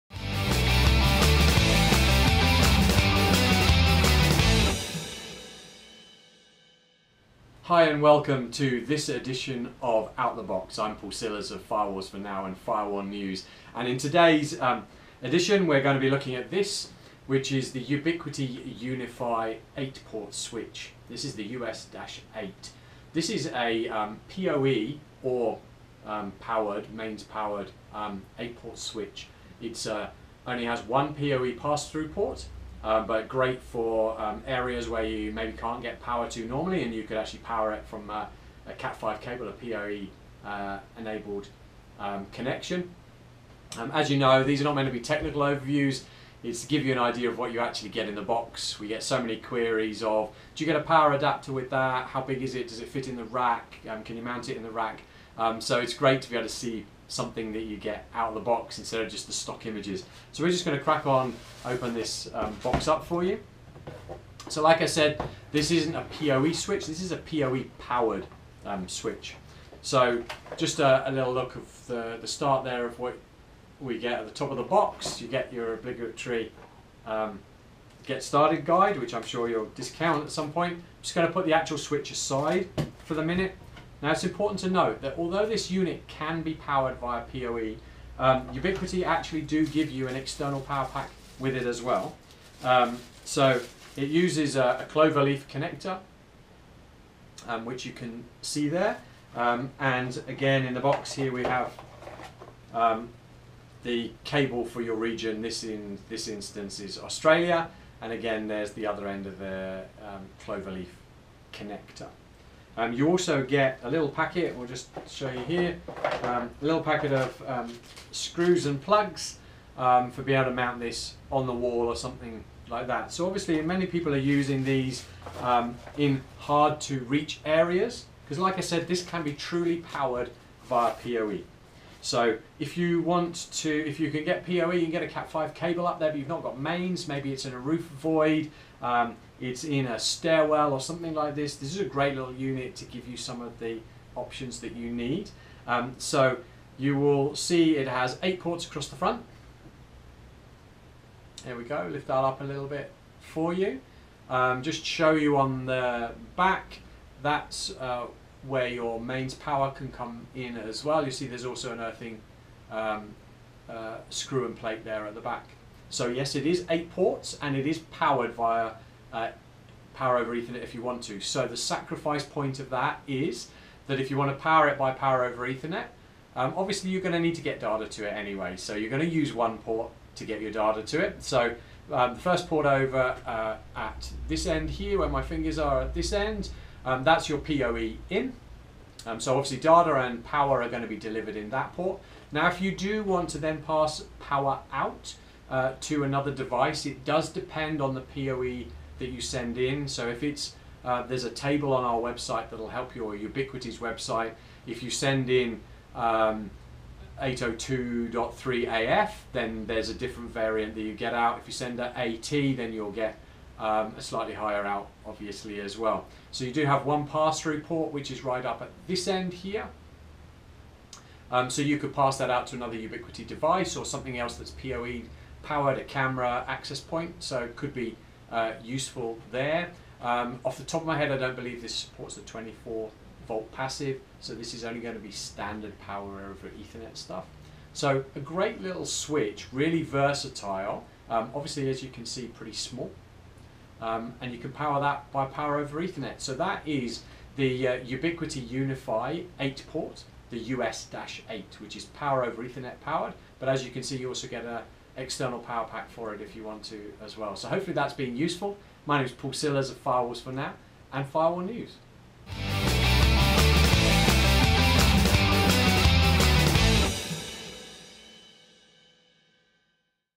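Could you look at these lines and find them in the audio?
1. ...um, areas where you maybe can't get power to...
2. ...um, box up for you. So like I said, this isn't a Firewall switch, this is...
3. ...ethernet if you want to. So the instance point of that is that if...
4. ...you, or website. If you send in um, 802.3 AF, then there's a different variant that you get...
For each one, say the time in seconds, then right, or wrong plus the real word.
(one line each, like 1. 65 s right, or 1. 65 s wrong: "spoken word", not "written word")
1. 34 s right
2. 62 s wrong: "PoE", not "Firewall"
3. 170 s wrong: "sacrifice", not "instance"
4. 202 s right.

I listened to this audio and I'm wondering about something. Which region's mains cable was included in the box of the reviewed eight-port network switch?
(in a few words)
Australia.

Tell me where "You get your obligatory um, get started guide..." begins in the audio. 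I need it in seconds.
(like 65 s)
75 s.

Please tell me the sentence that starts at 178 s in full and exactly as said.
So you're going to use one port to get your data to it.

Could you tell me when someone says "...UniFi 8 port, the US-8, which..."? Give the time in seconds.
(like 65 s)
248 s.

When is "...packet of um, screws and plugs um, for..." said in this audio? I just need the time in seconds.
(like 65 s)
116 s.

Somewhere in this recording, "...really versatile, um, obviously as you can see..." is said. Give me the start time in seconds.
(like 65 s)
239 s.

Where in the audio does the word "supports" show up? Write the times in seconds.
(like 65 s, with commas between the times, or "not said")
231 s.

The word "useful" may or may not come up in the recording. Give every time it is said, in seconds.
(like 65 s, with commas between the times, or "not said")
228 s, 258 s.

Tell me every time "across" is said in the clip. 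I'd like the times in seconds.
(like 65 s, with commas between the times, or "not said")
148 s.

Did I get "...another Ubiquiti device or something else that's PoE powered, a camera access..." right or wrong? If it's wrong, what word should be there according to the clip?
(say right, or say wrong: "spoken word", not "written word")
right.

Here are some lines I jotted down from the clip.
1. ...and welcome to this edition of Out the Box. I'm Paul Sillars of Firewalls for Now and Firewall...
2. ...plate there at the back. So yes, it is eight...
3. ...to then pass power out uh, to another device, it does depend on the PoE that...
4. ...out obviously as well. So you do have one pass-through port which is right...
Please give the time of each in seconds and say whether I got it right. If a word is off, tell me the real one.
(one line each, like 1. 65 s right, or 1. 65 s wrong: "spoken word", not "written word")
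1. 7 s right
2. 164 s right
3. 193 s right
4. 214 s right.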